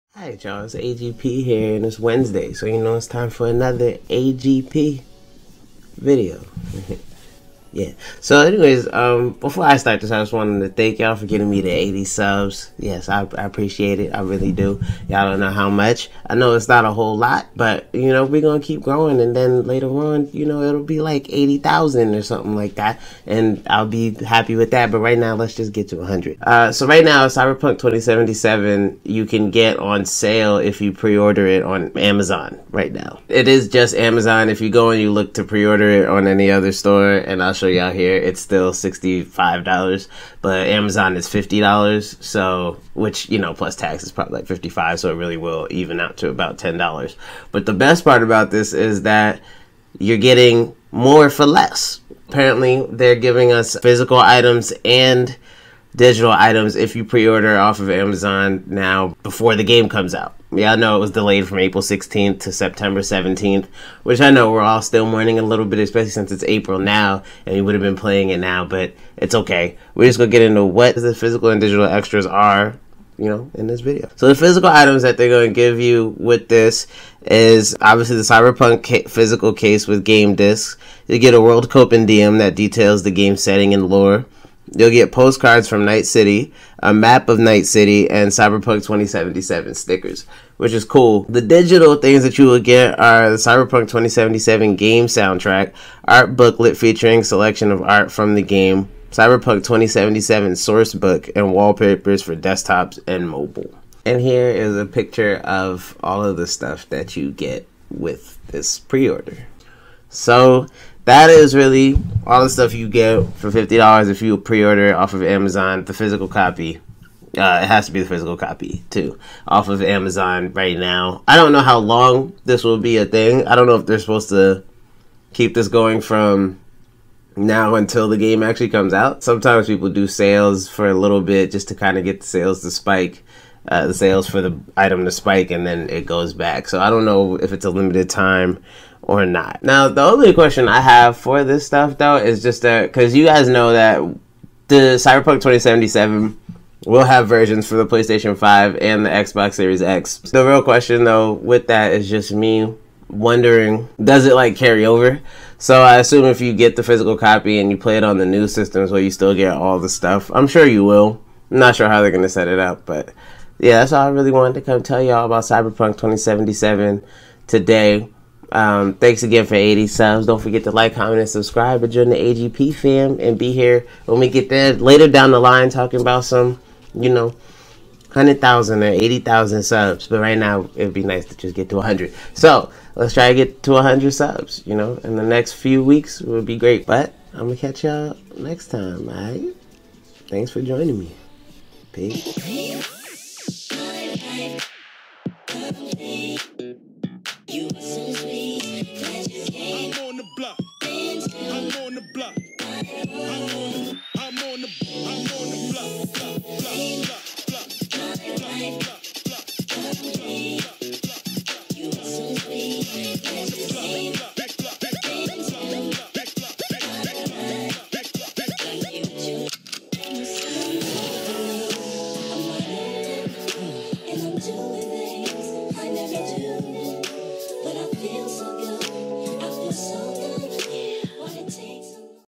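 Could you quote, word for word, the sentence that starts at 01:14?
So the physical items that they're going to give you with this is obviously the Cyberpunk ca physical case with game discs.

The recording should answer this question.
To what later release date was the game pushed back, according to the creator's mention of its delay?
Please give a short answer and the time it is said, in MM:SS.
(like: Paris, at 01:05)
September 17th, at 01:02.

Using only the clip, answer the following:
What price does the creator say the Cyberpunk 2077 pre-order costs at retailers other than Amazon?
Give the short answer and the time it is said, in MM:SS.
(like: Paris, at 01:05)
$65, at 00:38.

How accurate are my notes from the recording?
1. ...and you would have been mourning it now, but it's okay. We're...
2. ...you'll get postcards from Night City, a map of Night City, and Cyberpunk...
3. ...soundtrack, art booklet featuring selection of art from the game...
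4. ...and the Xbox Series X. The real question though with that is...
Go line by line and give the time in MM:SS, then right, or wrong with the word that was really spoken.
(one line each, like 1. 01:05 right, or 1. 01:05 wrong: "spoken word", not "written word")
1. 01:07 wrong: "playing", not "mourning"
2. 01:24 right
3. 01:35 right
4. 02:28 right.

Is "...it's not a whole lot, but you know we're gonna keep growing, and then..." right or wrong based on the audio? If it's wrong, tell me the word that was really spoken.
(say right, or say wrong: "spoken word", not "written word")
right.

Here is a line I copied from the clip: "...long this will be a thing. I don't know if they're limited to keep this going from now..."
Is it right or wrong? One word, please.
wrong.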